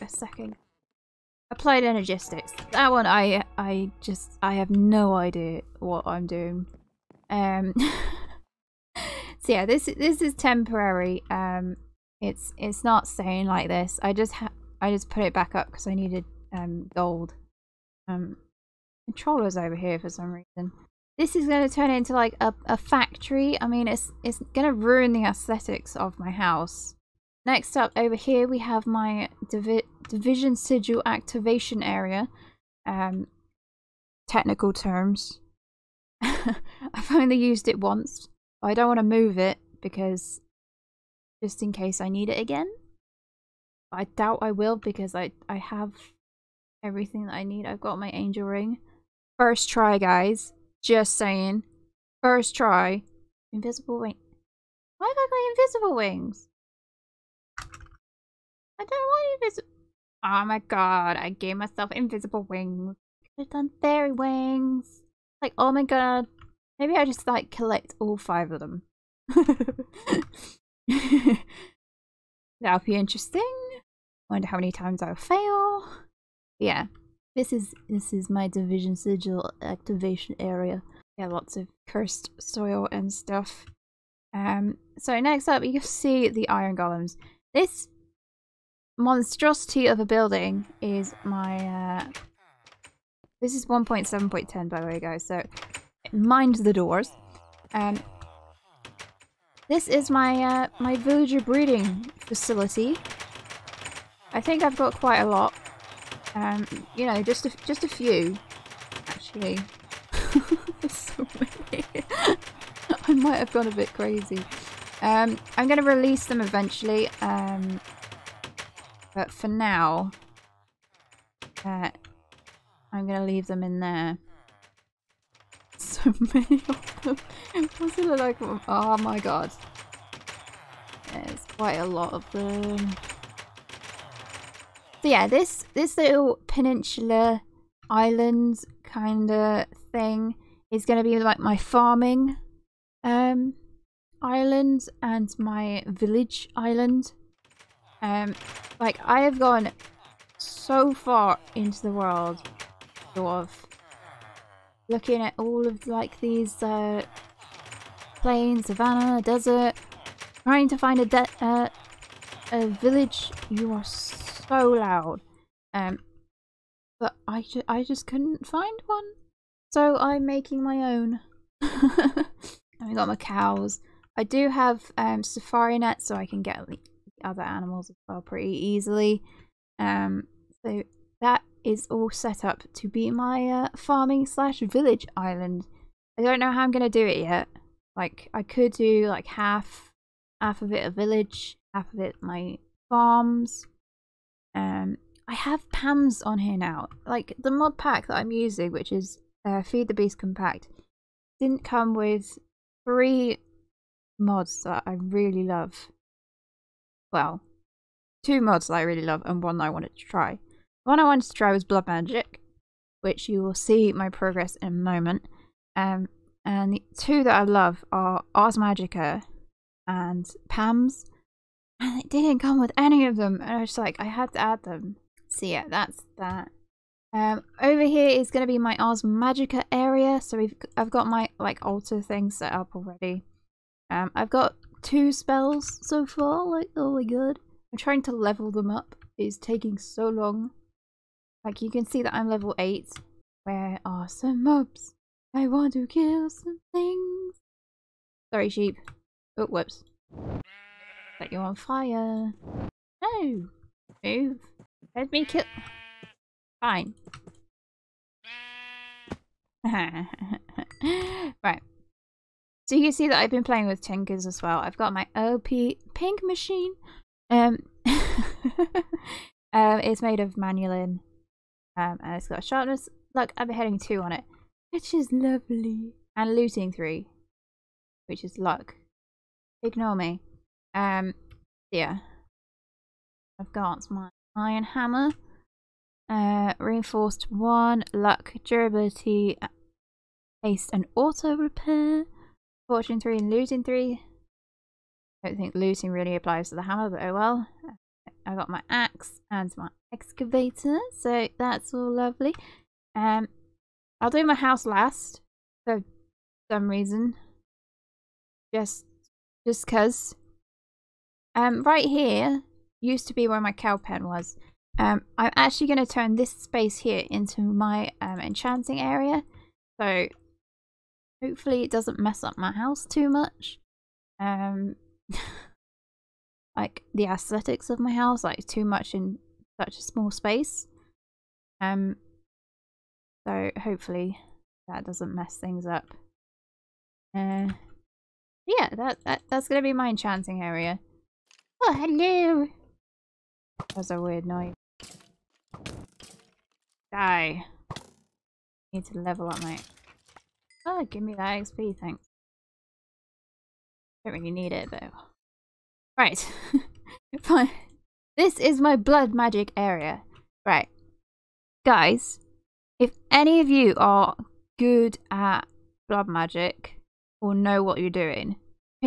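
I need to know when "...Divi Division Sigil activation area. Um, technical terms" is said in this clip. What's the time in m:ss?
0:29.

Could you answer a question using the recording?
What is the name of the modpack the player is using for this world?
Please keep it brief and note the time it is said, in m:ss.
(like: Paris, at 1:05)
Feed the Beast Compact, at 3:19.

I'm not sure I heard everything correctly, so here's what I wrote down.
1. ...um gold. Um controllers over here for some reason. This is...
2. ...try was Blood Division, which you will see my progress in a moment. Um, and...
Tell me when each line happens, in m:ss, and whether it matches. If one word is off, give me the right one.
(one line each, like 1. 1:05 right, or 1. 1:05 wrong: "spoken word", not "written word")
1. 0:16 right
2. 3:31 wrong: "Magic", not "Division".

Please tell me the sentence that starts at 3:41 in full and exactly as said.
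And it didn't come with any of them.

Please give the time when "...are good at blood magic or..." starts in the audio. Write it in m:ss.
6:03.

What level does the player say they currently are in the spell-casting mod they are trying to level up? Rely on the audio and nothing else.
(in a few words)
8.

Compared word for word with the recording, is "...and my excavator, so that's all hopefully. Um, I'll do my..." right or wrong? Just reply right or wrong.
wrong.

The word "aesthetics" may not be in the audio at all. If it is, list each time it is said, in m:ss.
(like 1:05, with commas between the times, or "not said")
0:25, 5:27.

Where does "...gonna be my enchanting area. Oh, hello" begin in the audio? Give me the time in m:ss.
5:39.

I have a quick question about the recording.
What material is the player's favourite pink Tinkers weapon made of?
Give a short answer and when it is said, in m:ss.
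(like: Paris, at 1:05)
manyullyn, at 4:30.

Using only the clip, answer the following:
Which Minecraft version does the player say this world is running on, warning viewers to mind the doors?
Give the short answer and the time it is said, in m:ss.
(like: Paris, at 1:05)
1.7.10, at 1:33.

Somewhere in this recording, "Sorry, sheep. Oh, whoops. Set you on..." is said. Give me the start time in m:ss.
4:08.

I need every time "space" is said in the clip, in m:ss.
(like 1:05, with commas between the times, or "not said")
5:16, 5:30.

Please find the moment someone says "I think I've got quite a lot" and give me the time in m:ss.
1:44.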